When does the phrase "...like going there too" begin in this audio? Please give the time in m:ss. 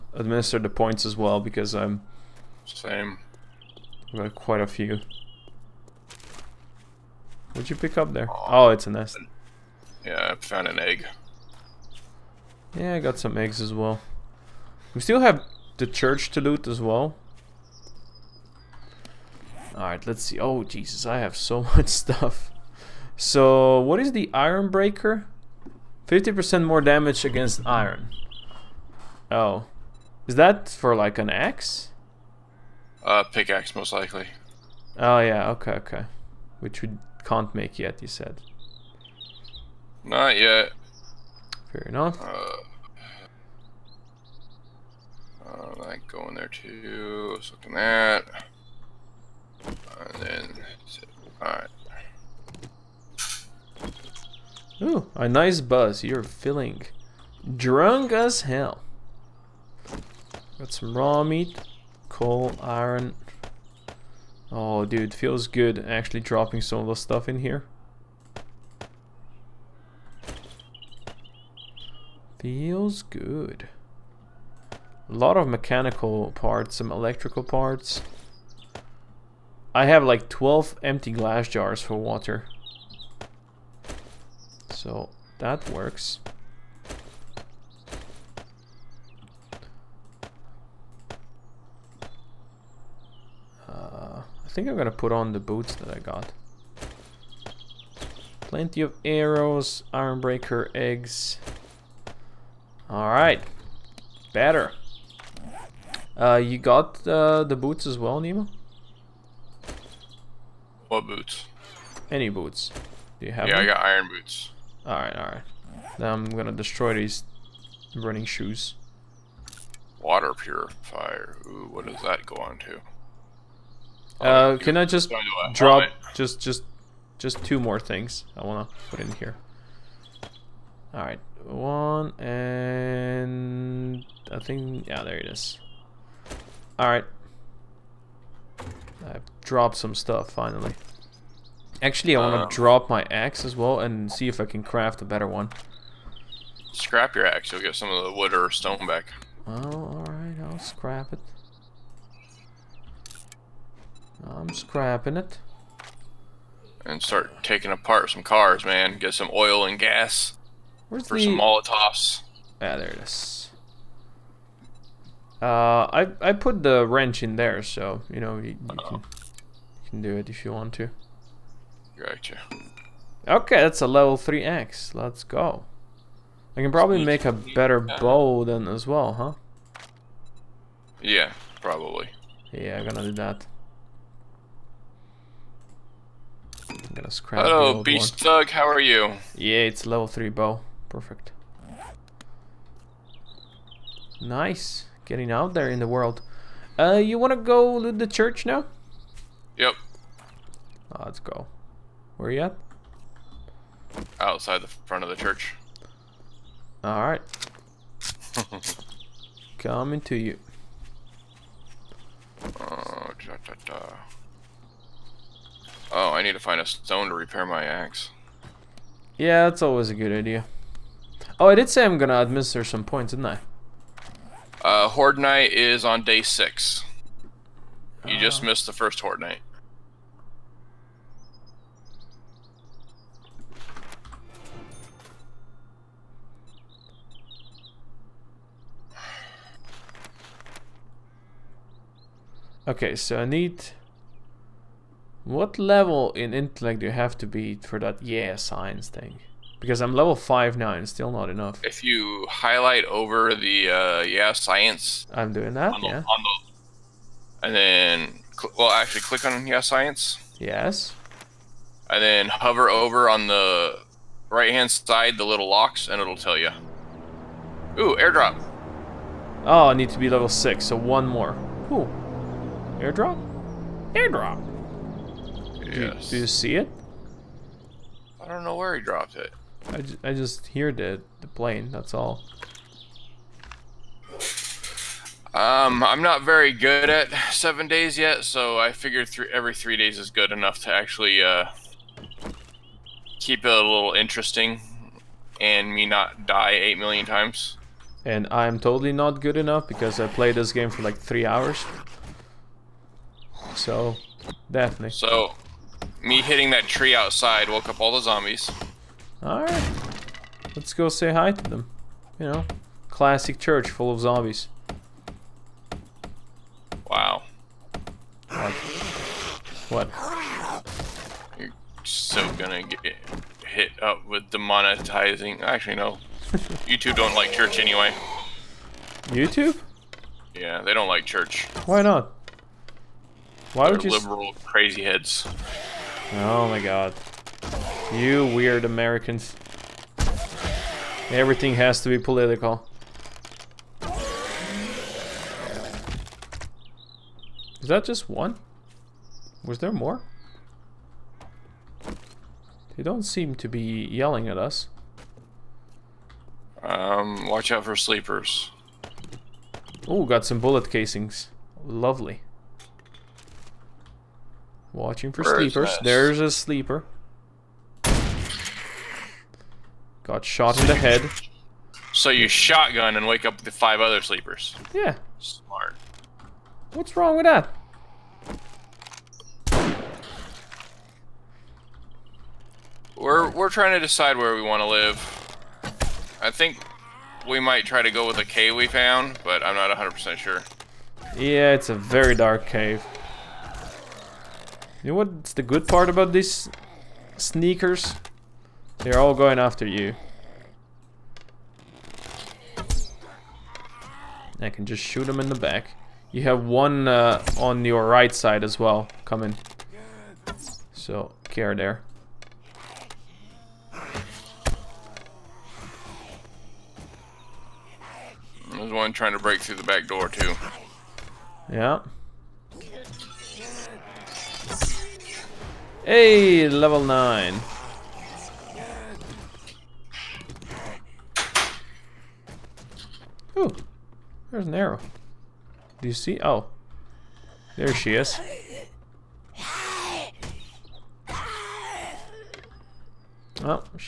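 0:45.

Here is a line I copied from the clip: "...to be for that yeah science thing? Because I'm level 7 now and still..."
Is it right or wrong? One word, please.
wrong.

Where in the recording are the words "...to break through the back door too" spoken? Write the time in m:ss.
6:59.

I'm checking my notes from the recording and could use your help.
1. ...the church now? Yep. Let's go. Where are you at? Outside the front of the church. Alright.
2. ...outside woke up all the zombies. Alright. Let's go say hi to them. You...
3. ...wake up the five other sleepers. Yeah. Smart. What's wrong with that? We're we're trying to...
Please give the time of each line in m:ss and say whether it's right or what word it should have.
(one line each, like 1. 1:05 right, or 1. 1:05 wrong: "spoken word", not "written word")
1. 3:17 right
2. 5:06 right
3. 6:13 right.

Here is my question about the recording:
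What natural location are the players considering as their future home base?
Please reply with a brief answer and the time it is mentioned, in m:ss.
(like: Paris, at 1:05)
A cave, at 6:28.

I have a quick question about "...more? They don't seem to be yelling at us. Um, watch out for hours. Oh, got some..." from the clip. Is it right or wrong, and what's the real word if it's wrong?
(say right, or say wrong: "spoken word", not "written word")
wrong: "sleepers", not "hours".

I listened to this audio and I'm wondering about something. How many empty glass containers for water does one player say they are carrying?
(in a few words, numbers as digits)
12.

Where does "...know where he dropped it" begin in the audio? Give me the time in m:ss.
4:38.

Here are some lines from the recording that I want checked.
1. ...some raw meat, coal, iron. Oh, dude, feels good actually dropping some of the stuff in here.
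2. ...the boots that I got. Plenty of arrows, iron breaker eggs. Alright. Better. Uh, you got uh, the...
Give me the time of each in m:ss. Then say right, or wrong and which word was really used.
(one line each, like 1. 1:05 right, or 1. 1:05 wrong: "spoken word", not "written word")
1. 1:00 right
2. 1:35 right.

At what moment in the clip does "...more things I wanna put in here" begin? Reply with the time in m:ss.
2:07.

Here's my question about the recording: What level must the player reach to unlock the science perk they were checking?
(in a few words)
6.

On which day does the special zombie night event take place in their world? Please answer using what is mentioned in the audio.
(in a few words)
Day 6.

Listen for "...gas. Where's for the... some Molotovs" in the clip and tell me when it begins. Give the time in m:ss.
2:39.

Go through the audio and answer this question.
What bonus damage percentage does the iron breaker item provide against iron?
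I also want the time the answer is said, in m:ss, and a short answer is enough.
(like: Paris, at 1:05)
50%, at 0:26.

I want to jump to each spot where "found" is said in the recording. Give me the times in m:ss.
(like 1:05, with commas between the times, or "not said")
0:10, 6:28.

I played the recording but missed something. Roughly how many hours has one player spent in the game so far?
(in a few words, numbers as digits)
3 hours.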